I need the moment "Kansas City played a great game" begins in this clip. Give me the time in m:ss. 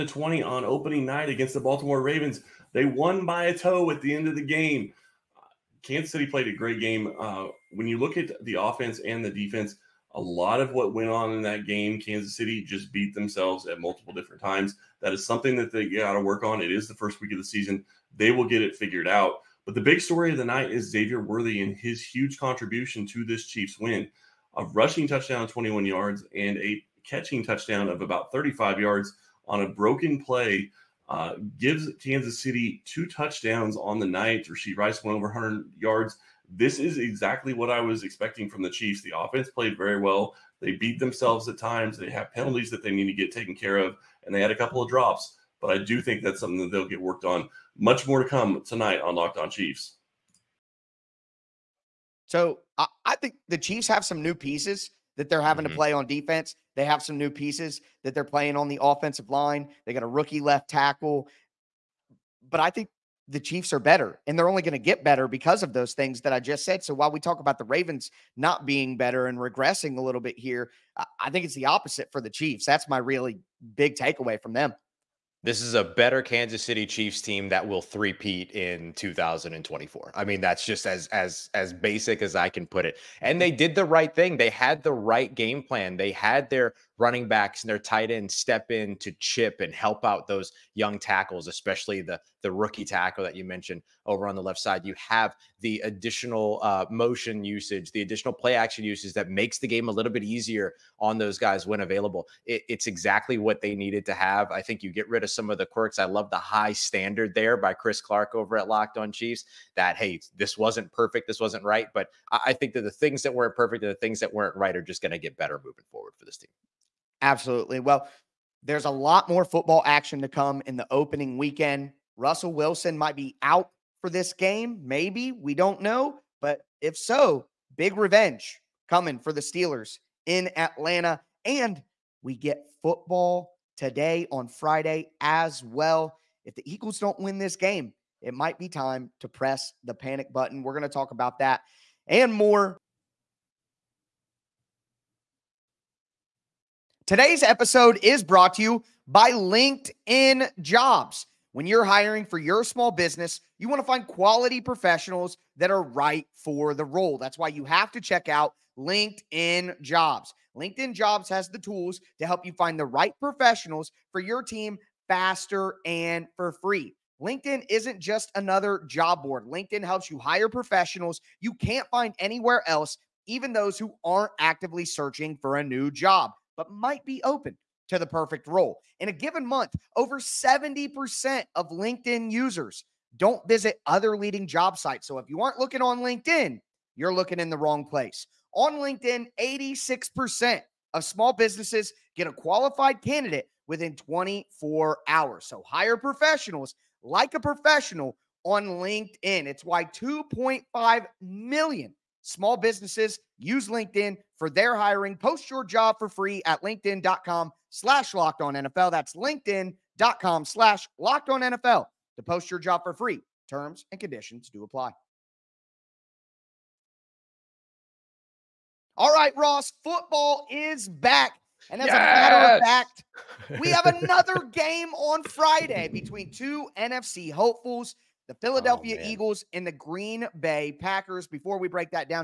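0:05.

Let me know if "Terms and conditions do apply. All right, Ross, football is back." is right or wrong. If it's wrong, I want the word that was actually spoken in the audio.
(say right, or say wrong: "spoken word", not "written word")
right.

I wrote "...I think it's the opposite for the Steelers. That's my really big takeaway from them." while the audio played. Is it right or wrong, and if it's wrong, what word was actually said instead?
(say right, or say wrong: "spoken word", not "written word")
wrong: "Chiefs", not "Steelers".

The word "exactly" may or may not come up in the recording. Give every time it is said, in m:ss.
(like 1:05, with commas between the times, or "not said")
0:36, 1:42.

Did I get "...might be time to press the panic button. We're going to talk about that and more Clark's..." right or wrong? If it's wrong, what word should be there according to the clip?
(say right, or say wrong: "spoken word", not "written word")
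wrong: "Today", not "Clark".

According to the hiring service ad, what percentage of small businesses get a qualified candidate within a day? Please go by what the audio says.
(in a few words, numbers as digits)
86%.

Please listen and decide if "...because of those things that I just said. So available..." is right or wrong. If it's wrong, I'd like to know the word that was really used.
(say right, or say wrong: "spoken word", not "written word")
wrong: "while", not "available".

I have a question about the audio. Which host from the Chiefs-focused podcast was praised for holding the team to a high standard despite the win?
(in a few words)
Chris Clark.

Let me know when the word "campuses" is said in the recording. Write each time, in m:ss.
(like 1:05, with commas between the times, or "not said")
not said.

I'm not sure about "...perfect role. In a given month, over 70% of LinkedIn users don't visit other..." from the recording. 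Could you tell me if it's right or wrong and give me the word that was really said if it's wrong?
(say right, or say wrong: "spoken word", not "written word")
right.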